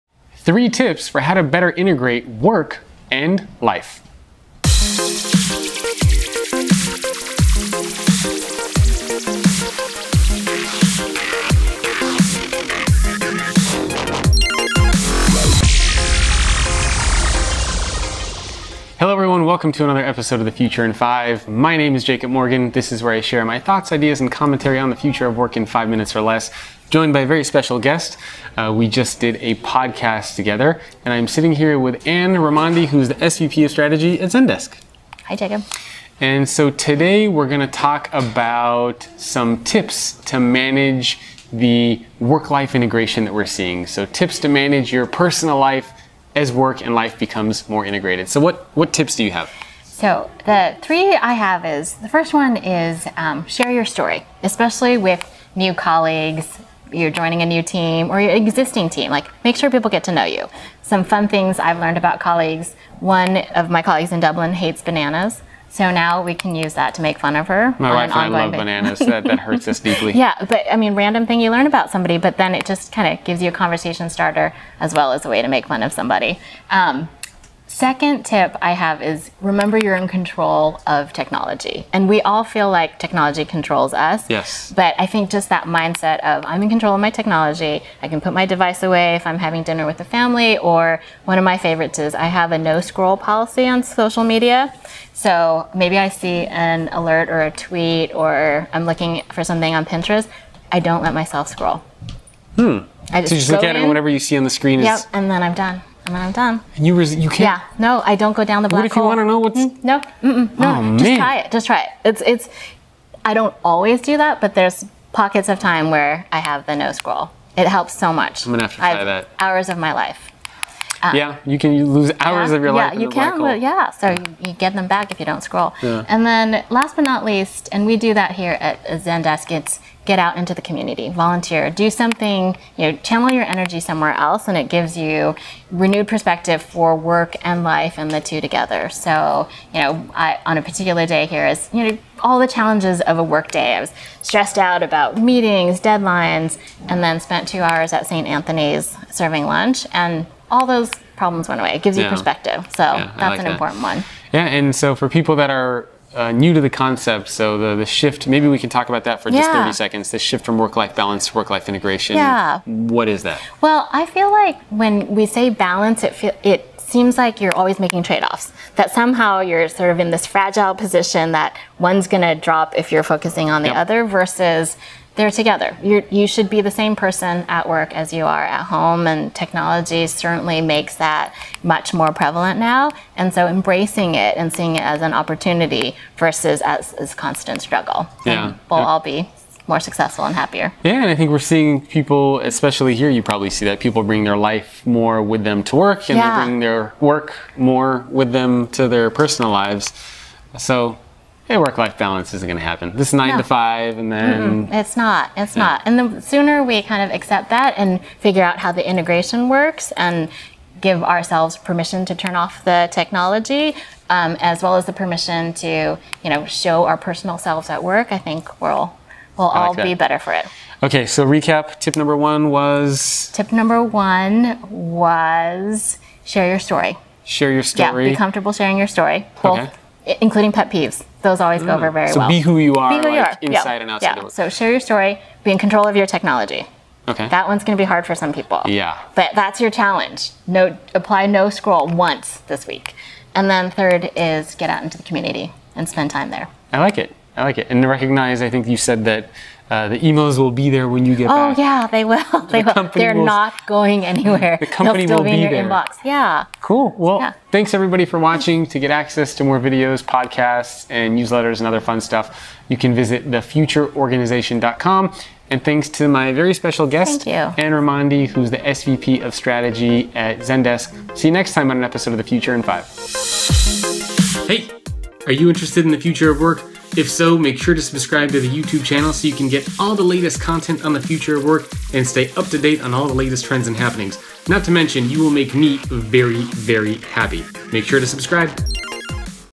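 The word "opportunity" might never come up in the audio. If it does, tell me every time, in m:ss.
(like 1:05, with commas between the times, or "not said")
3:05.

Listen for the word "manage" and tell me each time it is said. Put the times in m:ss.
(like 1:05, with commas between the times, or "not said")
0:40, 0:44.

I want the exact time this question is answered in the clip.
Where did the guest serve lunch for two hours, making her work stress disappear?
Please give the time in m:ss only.
2:28.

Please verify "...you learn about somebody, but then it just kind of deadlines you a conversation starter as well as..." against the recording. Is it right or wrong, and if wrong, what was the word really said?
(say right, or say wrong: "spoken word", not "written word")
wrong: "gives", not "deadlines".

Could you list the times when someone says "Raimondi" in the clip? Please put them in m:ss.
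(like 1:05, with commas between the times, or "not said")
0:32, 4:27.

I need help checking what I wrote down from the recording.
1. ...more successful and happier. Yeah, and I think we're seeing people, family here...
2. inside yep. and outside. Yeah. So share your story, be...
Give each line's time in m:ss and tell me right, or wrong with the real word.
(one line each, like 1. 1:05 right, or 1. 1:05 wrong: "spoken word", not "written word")
1. 3:09 wrong: "especially", not "family"
2. 3:53 right.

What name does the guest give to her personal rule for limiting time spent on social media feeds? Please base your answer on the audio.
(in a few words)
No scroll policy.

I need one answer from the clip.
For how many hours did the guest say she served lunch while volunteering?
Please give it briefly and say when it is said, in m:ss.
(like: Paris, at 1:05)
2, at 2:27.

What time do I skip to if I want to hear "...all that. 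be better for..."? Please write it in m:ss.
3:39.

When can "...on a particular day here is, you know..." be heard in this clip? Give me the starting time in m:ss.
2:20.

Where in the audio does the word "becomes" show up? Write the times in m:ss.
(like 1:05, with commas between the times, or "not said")
0:47.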